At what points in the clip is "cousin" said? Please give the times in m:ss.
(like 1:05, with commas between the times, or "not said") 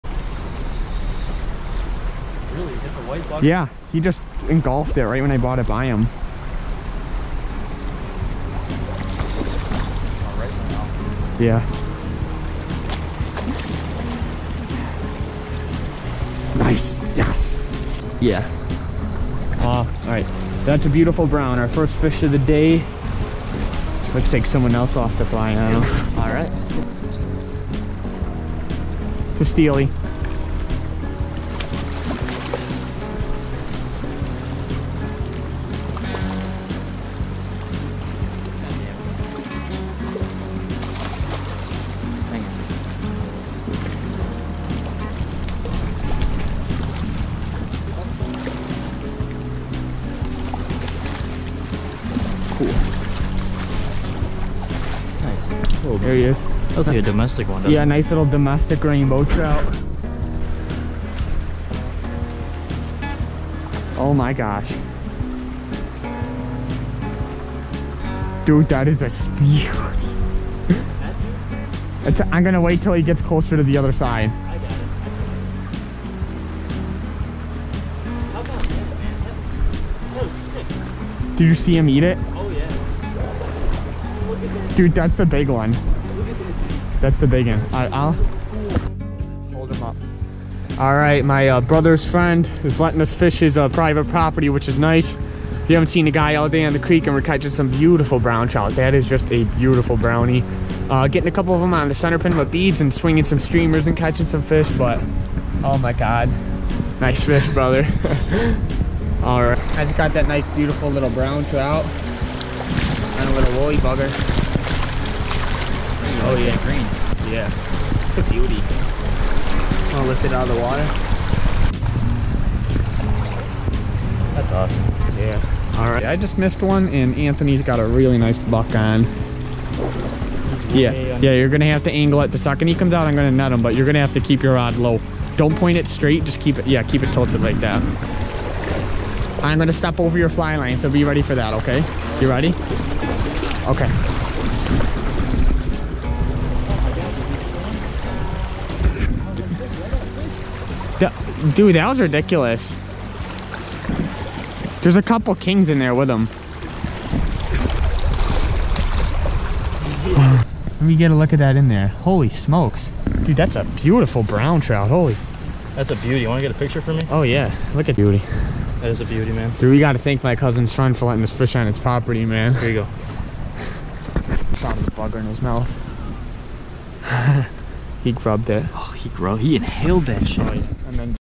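2:50.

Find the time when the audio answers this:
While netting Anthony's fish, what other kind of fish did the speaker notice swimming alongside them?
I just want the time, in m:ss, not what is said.
2:35.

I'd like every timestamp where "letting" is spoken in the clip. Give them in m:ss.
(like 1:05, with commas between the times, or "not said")
1:32, 2:51.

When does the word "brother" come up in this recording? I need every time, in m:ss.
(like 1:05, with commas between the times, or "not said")
1:31, 1:47.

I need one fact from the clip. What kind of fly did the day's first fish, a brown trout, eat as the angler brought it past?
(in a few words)
White bugger.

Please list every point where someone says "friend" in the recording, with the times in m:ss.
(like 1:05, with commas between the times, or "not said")
1:32, 2:50.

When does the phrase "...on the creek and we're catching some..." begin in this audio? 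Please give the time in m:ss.
1:36.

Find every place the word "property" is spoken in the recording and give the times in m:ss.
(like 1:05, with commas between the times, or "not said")
1:34, 2:51.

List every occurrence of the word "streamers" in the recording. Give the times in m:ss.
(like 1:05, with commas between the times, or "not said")
1:43.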